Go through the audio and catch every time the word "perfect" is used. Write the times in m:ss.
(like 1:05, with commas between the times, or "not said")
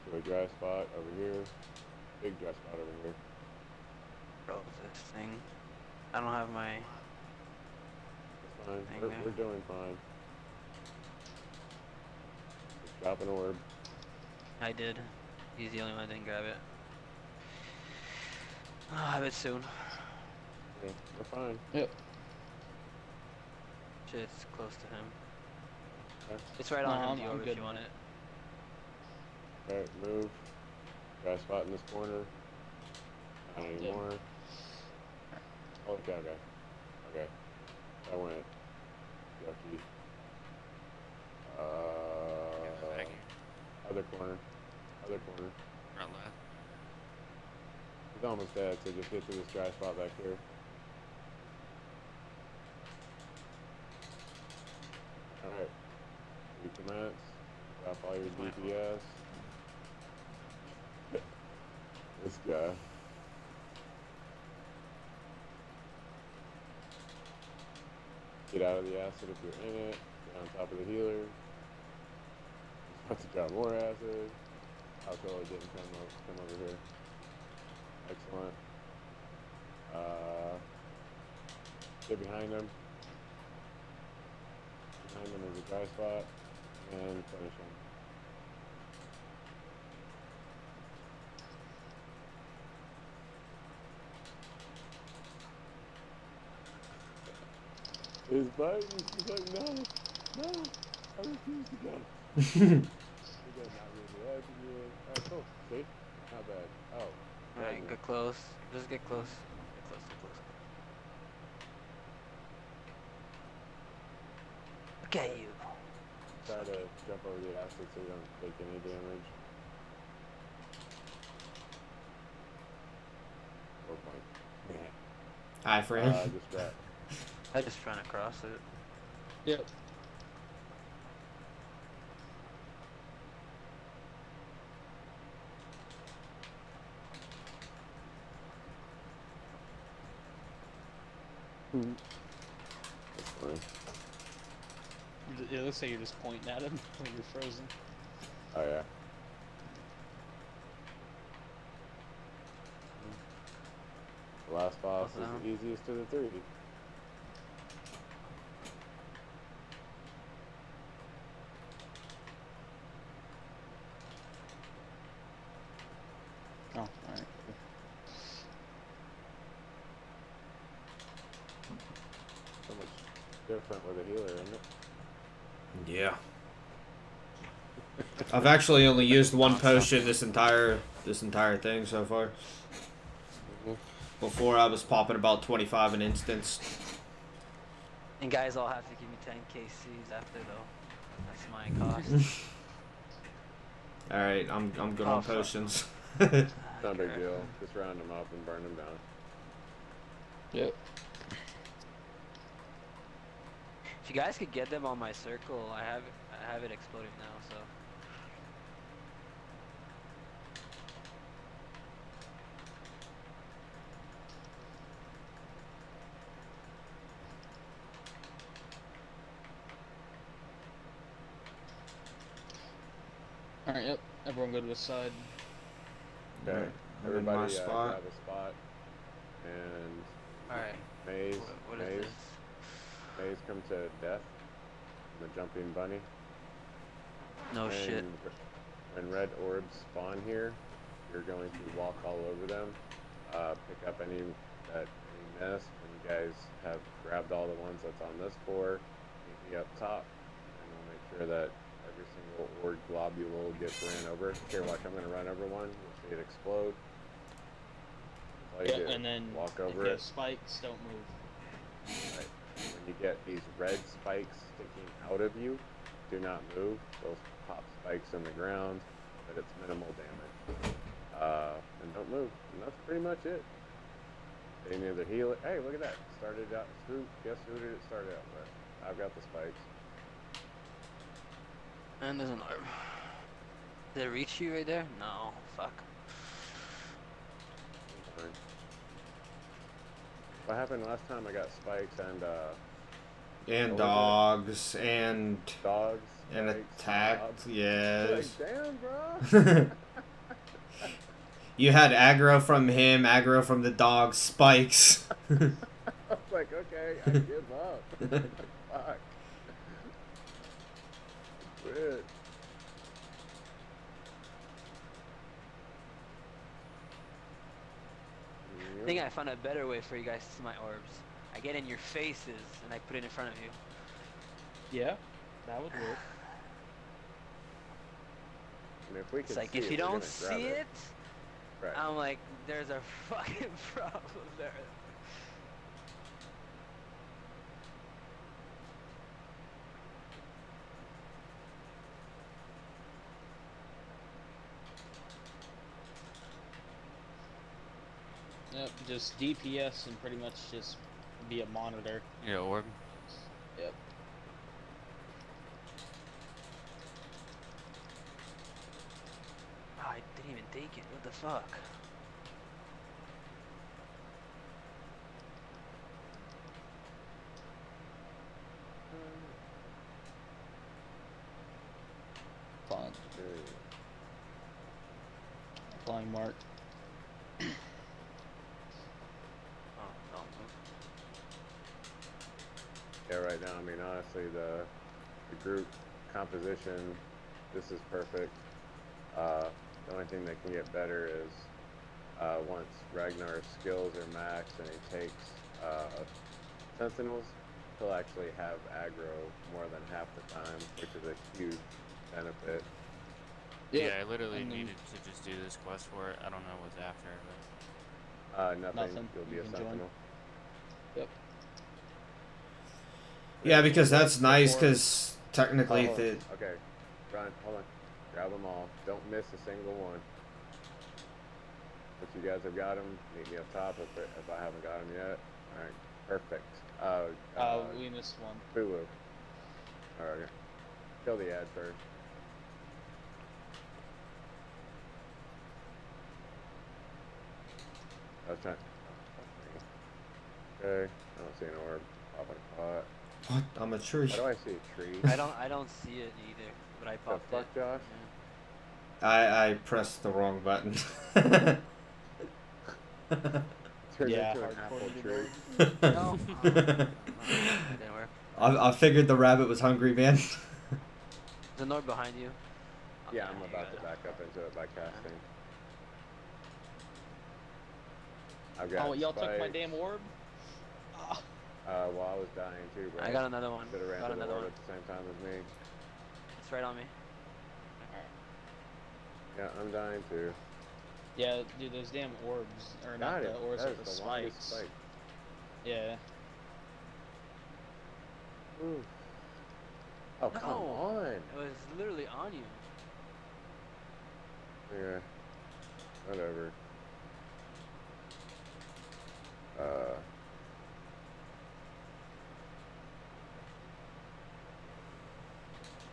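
6:27, 7:06.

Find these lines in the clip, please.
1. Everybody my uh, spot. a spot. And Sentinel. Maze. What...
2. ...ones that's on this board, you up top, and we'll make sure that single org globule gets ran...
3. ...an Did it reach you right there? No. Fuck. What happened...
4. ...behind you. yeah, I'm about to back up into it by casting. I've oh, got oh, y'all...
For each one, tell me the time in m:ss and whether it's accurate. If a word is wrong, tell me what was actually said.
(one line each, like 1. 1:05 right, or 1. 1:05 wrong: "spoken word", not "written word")
1. 3:47 wrong: "Alright", not "Sentinel"
2. 4:07 right
3. 4:42 right
4. 7:41 right.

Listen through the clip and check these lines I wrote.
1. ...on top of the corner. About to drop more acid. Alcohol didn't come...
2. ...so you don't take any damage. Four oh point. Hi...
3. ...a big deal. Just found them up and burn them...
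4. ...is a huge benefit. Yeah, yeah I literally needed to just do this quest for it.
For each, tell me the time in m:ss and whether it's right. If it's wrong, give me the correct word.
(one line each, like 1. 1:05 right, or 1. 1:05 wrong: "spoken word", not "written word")
1. 1:10 wrong: "healer", not "corner"
2. 1:57 right
3. 3:16 wrong: "round", not "found"
4. 6:40 right.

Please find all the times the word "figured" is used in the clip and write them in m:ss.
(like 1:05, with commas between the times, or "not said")
7:38.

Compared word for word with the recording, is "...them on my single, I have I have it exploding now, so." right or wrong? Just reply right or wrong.
wrong.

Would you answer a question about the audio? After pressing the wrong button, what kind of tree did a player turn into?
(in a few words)
Apple tree.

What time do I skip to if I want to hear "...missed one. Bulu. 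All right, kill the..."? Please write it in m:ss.
7:07.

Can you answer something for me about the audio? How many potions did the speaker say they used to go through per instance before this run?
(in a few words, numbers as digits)
25.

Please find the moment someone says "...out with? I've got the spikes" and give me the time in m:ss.
4:38.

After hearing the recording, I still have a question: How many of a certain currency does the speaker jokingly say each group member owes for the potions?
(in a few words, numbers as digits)
10 KCs.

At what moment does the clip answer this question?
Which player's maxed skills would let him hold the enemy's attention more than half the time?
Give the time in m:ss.
6:32.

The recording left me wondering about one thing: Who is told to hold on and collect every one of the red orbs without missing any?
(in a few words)
Ryan.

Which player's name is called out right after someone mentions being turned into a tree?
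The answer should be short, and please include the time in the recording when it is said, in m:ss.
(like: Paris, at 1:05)
Josh, at 7:27.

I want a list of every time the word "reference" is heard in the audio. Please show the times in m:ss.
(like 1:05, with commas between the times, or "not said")
not said.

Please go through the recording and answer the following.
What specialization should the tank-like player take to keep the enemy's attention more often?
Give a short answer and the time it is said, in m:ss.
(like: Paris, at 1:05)
Sentinels, at 6:36.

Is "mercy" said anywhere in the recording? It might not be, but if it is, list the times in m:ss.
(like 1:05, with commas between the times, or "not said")
not said.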